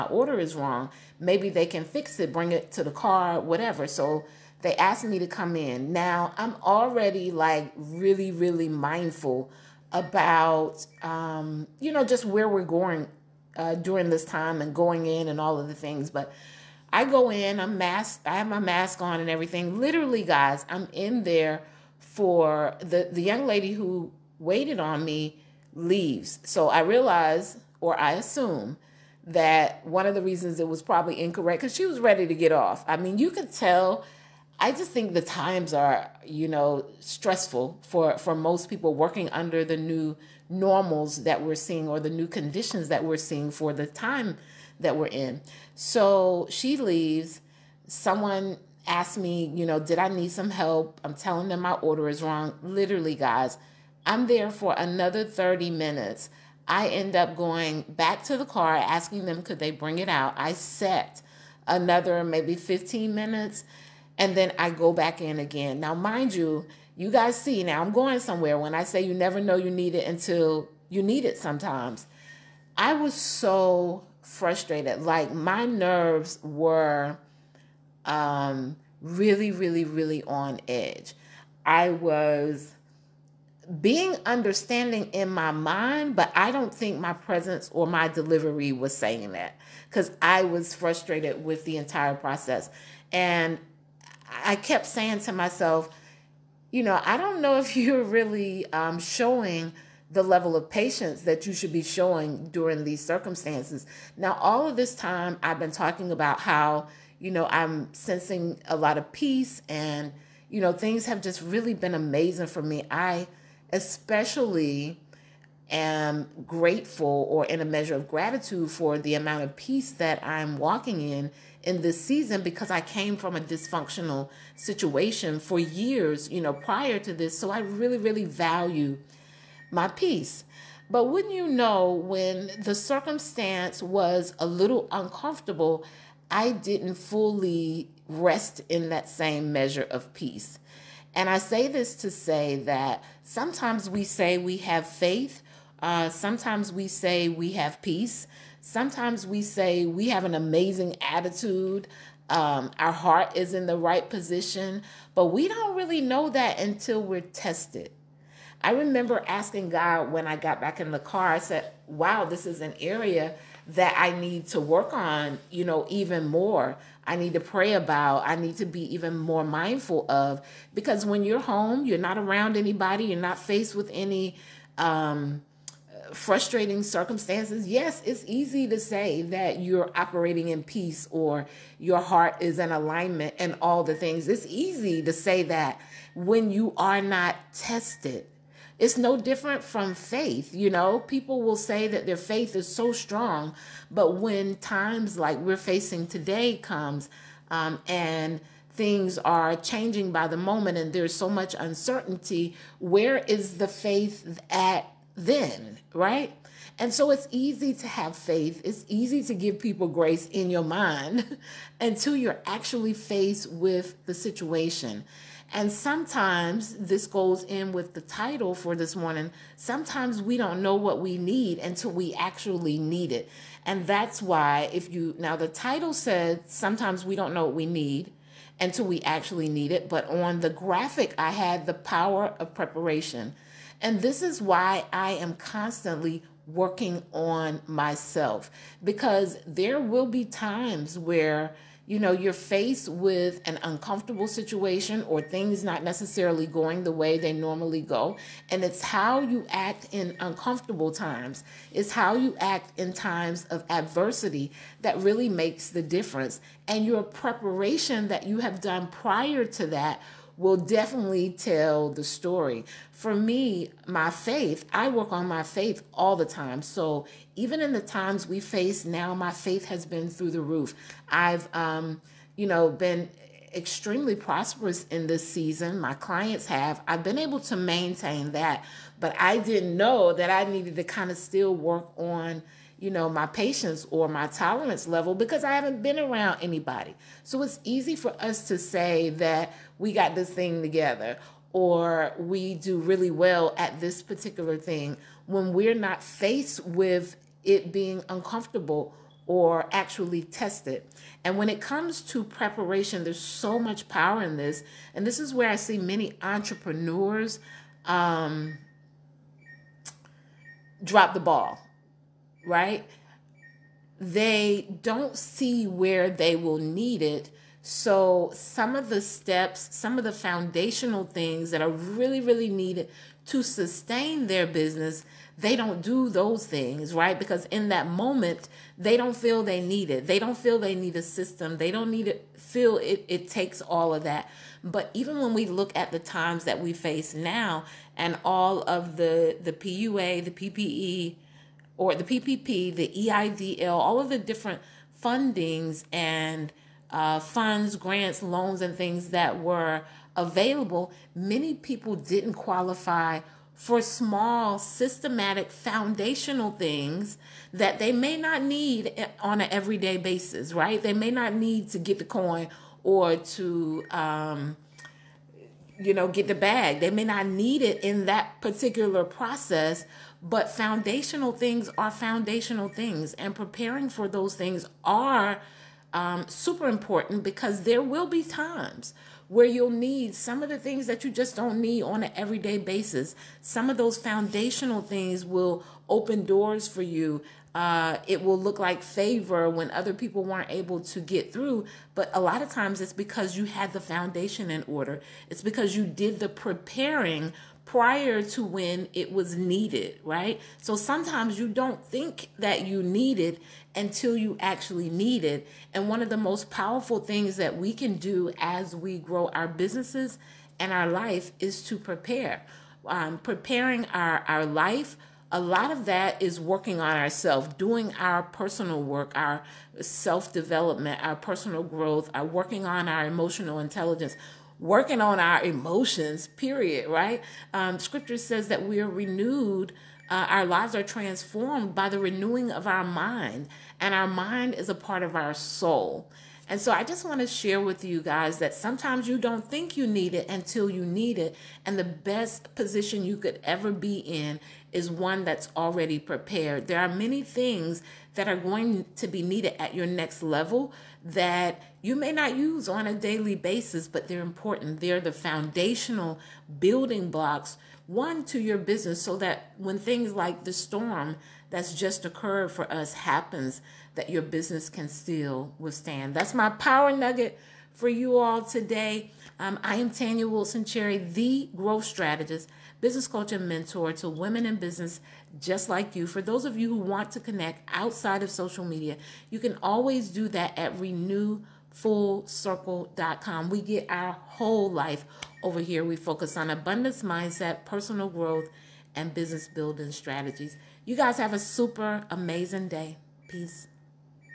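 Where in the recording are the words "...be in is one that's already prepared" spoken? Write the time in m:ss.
7:23.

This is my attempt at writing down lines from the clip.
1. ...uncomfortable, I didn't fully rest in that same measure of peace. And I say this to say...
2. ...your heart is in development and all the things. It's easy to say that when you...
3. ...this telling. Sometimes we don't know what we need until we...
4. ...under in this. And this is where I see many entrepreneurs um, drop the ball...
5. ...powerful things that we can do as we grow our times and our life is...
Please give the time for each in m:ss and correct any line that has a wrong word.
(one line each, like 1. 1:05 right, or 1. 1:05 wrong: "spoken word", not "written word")
1. 2:14 right
2. 3:01 wrong: "alignment", not "development"
3. 3:38 wrong: "morning", not "telling"
4. 5:03 wrong: "power", not "under"
5. 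6:46 wrong: "businesses", not "times".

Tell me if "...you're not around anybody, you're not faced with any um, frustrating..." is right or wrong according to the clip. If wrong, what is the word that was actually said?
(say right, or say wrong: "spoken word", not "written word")
right.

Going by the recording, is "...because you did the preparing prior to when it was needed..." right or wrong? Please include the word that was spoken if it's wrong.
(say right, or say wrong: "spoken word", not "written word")
right.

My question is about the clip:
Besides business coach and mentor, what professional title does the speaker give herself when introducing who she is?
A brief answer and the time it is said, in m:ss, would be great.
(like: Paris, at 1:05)
Growth strategist, at 7:51.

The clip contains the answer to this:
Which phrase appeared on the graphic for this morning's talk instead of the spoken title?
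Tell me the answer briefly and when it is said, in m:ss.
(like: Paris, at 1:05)
The power of preparation, at 3:51.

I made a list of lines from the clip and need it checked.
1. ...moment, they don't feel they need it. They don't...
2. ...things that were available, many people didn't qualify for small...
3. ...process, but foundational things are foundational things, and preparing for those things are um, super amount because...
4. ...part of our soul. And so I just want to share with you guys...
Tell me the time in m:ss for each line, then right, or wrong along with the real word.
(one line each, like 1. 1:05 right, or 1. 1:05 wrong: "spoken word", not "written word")
1. 5:27 right
2. 5:48 right
3. 6:09 wrong: "important", not "amount"
4. 7:14 right.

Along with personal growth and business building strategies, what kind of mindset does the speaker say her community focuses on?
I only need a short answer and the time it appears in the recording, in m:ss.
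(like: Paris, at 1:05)
Abundance mindset, at 8:06.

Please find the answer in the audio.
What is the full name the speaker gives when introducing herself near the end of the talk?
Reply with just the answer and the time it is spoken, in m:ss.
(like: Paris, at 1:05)
Tanya Wilson Cherry, at 7:49.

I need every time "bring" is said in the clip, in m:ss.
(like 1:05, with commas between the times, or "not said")
0:02, 0:59.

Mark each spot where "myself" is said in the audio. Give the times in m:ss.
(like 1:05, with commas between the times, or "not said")
1:35, 3:57.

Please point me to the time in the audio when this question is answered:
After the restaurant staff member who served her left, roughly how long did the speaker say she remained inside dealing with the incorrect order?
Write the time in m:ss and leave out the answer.
0:54.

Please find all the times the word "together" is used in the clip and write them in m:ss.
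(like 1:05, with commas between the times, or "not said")
4:50.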